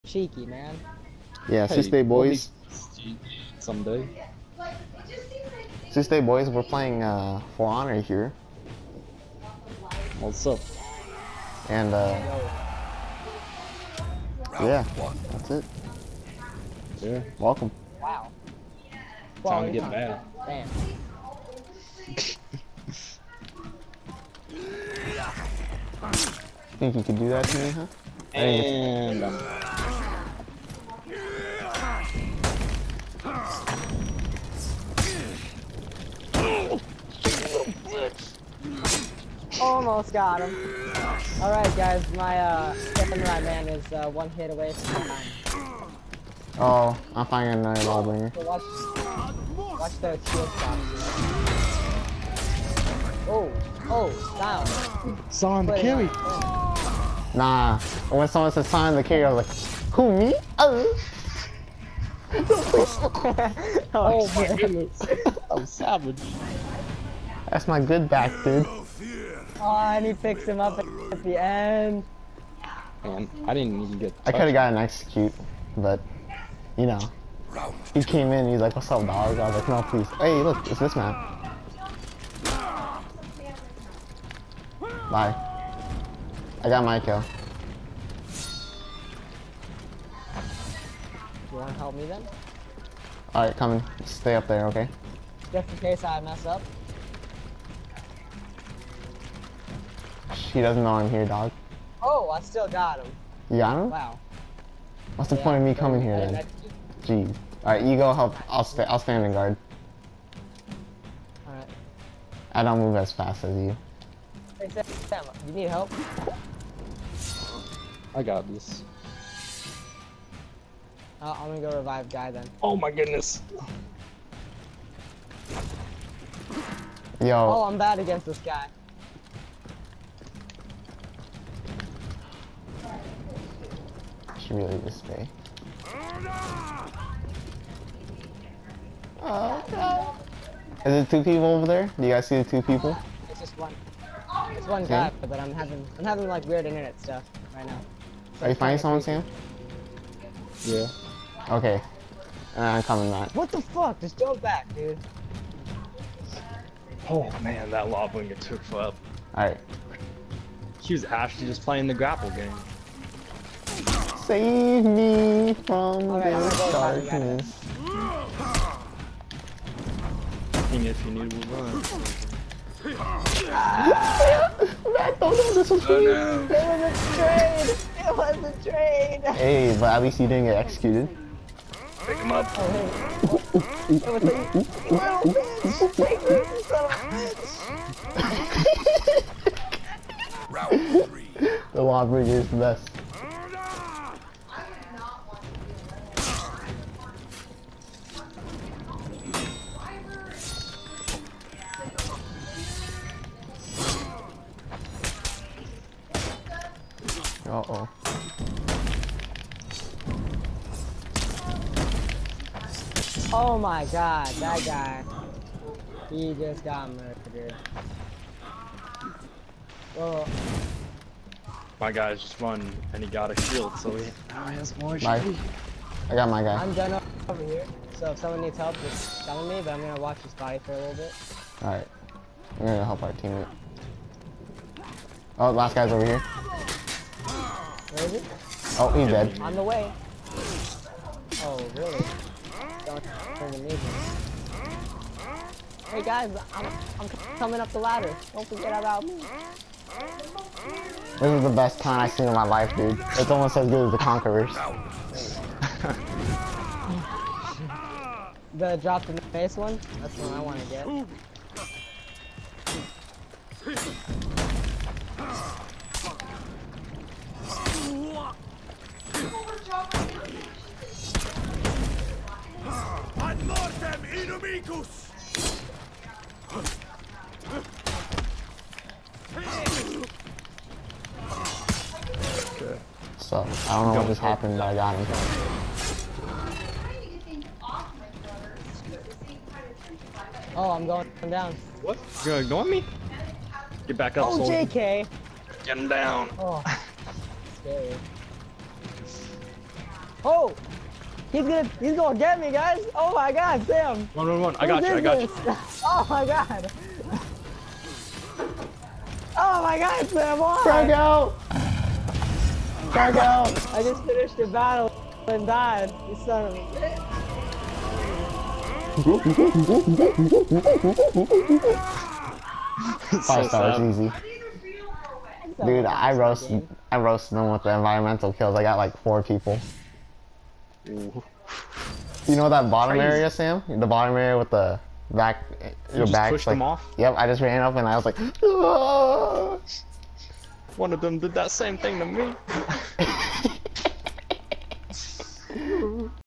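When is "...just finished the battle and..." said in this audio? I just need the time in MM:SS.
05:13.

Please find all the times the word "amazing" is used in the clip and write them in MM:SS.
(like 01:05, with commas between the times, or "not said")
04:03.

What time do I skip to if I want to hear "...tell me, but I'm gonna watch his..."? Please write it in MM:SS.
03:49.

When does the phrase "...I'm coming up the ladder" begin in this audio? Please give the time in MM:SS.
04:07.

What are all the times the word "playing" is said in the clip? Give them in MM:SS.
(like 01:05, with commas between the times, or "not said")
00:06, 02:41.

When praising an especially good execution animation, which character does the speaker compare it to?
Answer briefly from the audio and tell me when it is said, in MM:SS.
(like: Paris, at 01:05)
Conquerors, at 04:13.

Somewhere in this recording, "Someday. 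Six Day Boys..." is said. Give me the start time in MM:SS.
00:03.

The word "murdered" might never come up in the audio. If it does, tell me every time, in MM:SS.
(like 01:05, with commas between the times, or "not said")
03:36.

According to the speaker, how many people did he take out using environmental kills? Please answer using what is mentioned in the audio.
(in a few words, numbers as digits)
4.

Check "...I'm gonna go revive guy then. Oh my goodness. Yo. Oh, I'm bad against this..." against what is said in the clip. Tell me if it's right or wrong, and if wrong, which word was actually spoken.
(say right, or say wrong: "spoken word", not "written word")
right.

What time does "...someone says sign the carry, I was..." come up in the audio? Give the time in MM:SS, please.
00:58.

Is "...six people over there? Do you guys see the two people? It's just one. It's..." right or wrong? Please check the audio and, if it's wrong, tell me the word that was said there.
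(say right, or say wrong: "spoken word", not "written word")
wrong: "two", not "six".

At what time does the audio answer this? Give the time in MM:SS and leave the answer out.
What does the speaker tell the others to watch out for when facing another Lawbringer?
00:50.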